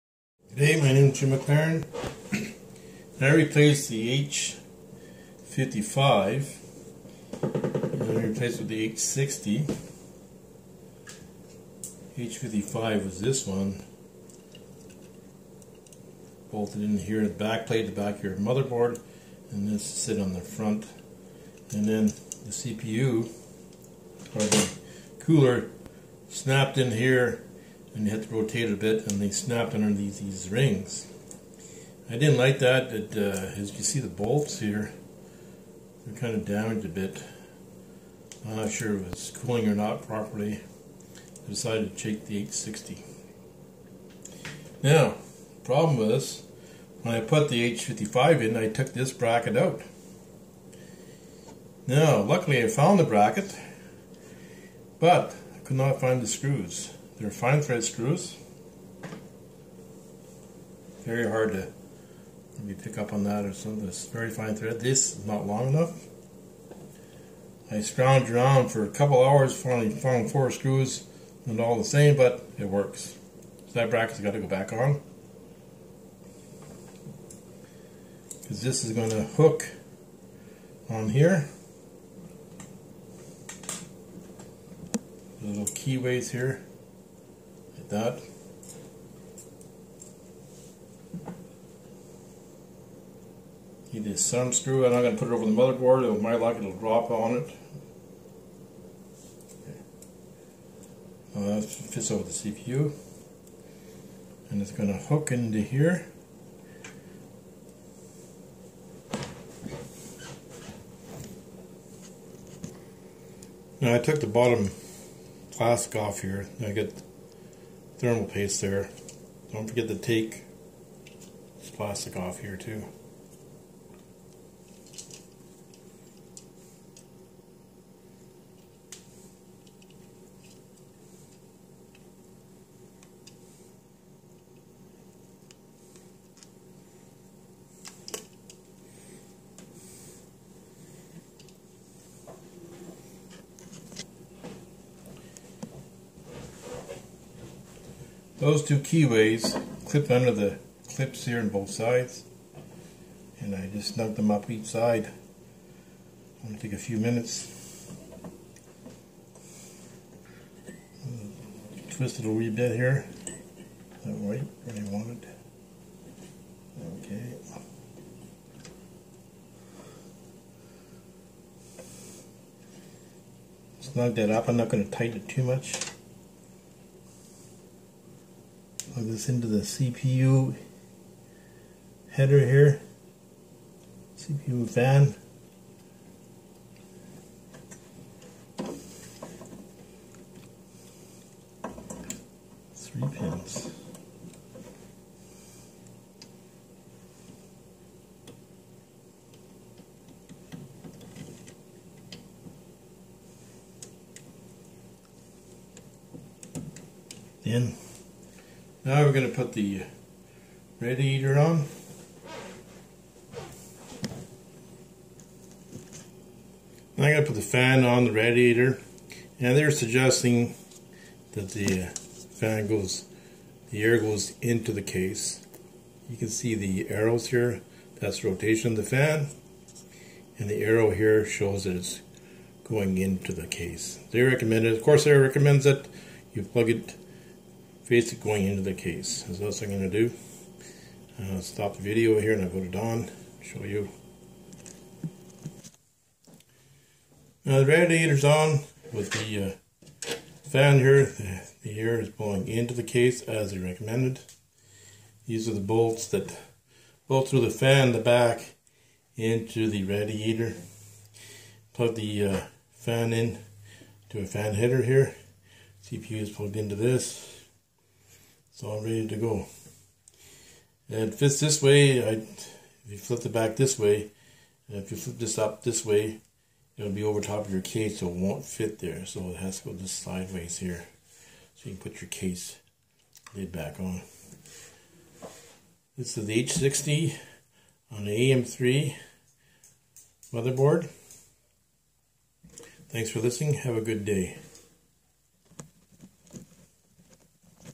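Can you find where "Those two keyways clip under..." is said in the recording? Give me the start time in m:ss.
2:28.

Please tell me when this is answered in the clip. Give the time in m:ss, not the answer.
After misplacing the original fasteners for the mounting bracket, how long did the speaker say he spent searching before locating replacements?
1:08.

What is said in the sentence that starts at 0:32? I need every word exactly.
I didn't like that, It uh, as you can see the bolts here, they're kind of damaged a bit.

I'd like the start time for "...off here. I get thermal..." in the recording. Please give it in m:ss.
1:56.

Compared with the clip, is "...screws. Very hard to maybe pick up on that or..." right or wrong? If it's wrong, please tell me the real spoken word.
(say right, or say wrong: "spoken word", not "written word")
right.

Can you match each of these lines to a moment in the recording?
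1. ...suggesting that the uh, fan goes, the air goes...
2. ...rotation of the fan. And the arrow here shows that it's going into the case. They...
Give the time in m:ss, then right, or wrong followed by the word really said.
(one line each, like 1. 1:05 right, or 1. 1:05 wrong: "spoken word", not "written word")
1. 3:39 right
2. 3:48 right.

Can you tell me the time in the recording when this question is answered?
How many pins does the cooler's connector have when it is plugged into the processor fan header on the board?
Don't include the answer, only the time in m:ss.
3:12.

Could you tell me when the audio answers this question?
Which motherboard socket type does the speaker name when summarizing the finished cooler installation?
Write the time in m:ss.
4:48.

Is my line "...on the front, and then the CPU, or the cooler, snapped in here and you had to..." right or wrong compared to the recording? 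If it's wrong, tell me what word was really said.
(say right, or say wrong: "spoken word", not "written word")
right.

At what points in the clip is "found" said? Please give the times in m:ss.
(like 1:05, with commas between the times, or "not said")
0:52, 1:09.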